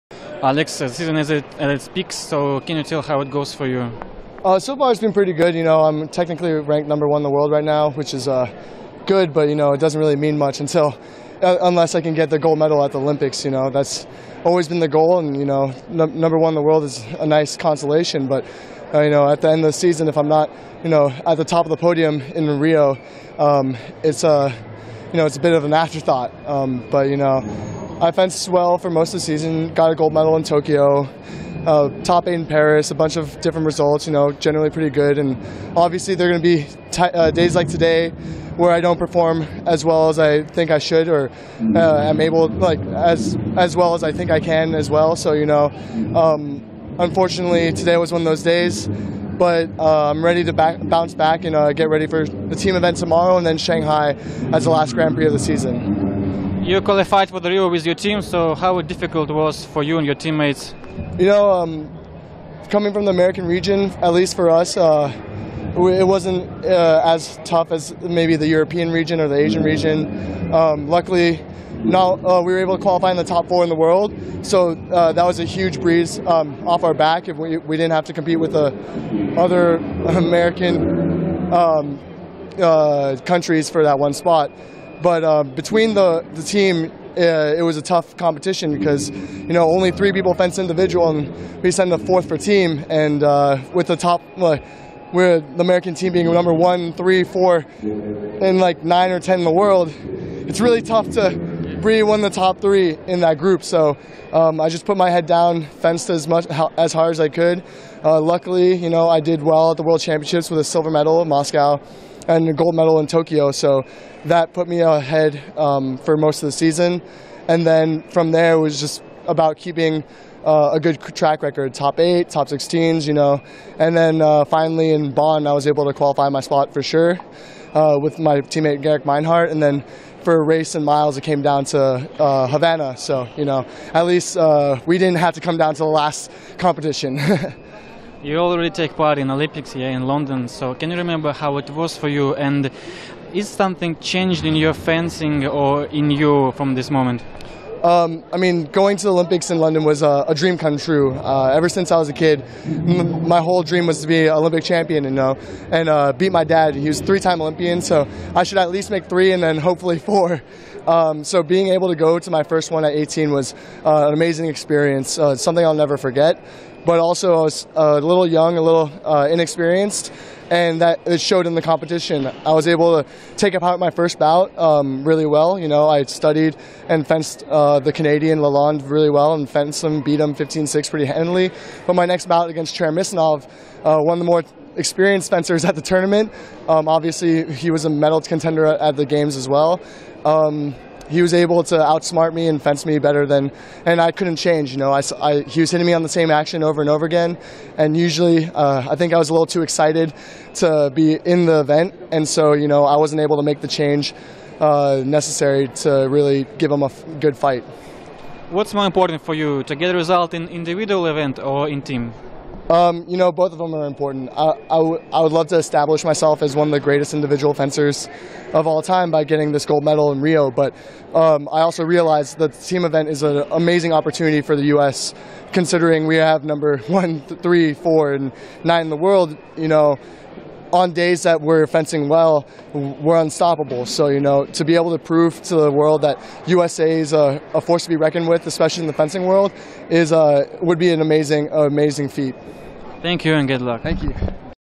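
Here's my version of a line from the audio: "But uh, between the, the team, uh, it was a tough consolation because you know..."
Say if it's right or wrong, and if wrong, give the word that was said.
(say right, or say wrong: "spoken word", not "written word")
wrong: "competition", not "consolation".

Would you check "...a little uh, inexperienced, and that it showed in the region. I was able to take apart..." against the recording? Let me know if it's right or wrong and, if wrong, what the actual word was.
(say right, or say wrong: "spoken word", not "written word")
wrong: "competition", not "region".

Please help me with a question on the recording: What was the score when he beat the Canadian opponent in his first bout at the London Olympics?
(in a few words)
15-6.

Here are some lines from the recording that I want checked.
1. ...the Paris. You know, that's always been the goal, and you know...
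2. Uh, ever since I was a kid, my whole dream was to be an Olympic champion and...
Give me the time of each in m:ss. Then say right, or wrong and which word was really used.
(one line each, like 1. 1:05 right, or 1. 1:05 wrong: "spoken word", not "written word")
1. 0:12 wrong: "Olympics", not "Paris"
2. 2:31 right.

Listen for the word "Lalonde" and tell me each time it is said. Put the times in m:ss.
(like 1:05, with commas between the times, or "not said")
2:58.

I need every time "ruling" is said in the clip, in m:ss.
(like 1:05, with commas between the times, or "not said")
not said.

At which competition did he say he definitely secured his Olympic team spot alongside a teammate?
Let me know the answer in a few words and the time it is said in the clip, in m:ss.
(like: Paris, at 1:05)
Bonn, at 2:05.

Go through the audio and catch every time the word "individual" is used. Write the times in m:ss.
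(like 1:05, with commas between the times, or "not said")
1:30, 3:30, 3:37.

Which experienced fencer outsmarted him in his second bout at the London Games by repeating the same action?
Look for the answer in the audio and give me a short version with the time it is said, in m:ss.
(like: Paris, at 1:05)
Cheremisinov, at 3:02.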